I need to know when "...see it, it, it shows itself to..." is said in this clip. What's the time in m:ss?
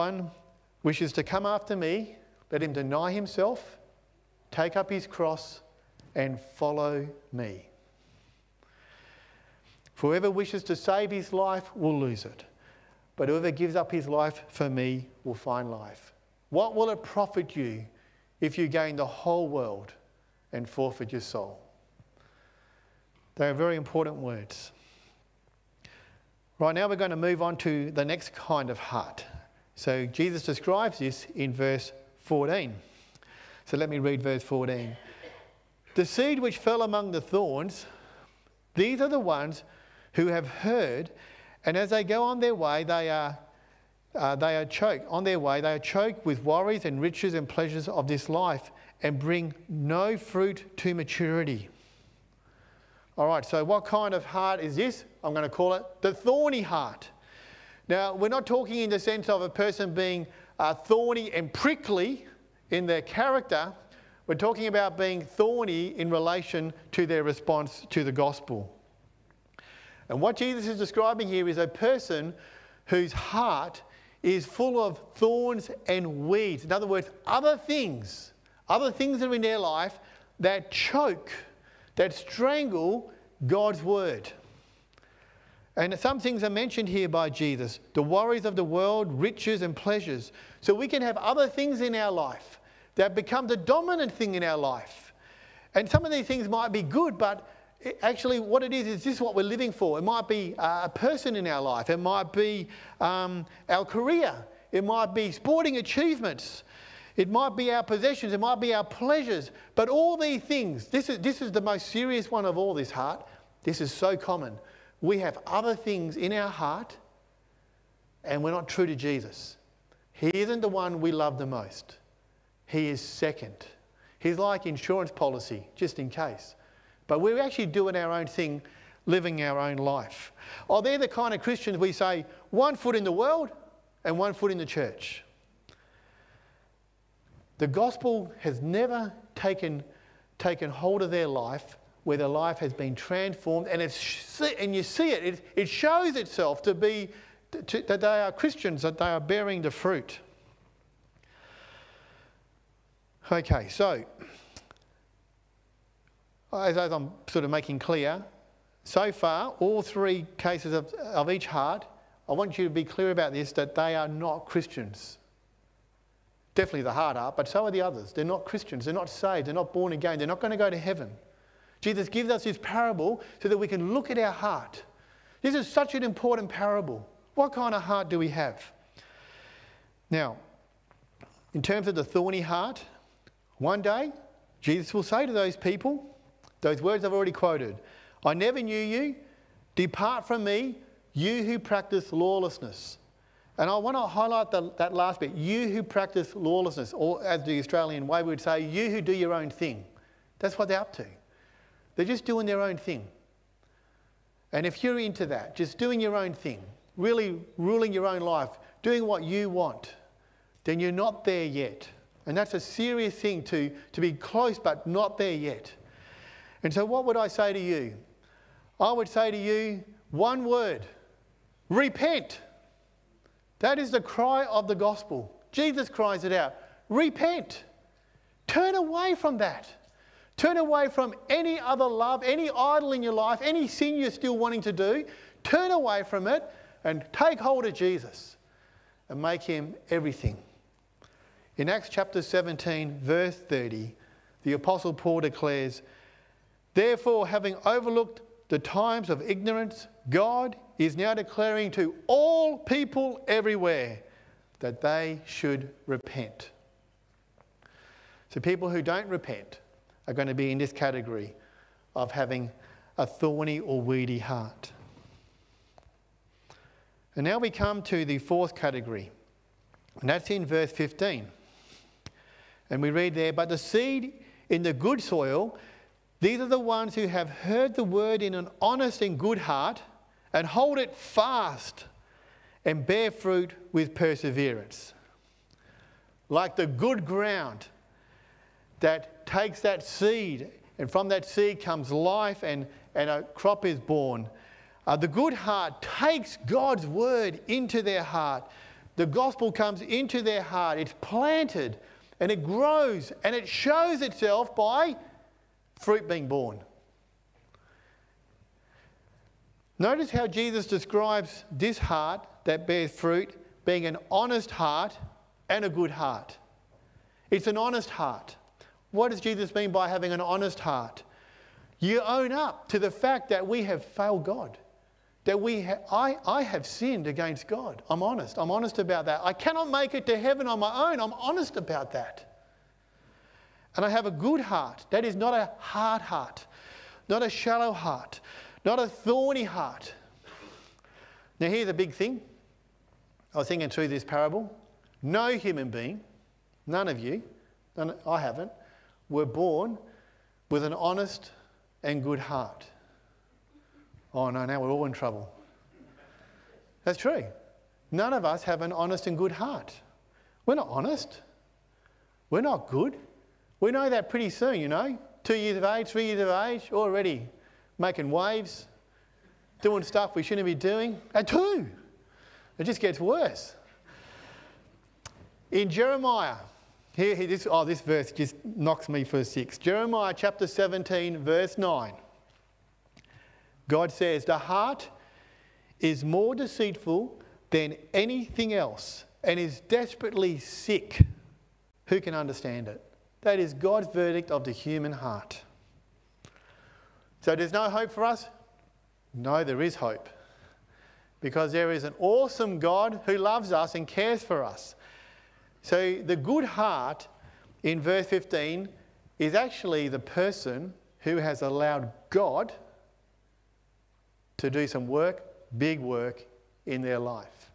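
2:24.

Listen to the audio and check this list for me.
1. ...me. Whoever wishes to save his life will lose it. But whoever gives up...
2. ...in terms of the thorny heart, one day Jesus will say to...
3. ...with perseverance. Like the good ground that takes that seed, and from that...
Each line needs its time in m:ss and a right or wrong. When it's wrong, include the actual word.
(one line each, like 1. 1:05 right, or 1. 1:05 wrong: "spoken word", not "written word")
1. 0:07 right
2. 3:01 right
3. 4:43 right.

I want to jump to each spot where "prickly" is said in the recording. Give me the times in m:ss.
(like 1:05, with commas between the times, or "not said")
1:01.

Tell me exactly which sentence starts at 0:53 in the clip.
All right, so what kind of heart is this?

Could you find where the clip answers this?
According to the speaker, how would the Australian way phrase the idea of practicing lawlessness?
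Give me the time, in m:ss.
3:18.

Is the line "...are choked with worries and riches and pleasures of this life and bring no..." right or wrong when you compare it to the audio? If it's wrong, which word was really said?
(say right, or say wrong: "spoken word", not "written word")
right.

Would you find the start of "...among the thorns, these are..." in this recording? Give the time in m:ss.
0:36.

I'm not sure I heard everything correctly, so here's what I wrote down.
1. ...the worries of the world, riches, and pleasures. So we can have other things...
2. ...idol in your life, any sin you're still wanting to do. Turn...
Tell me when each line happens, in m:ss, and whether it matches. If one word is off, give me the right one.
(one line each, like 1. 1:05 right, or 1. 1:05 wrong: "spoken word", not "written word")
1. 1:27 right
2. 3:52 right.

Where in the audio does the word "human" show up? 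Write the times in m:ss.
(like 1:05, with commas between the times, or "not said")
5:45, 6:34.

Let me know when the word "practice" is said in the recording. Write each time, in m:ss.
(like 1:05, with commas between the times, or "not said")
3:11, 3:15.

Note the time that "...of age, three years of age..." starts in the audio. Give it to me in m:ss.
6:05.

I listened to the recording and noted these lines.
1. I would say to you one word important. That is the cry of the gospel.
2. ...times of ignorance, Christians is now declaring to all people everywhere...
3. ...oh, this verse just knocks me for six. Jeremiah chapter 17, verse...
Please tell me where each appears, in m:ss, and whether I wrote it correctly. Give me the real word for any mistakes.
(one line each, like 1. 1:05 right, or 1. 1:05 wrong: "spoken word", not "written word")
1. 3:38 wrong: "repent", not "important"
2. 4:08 wrong: "God", not "Christians"
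3. 6:17 right.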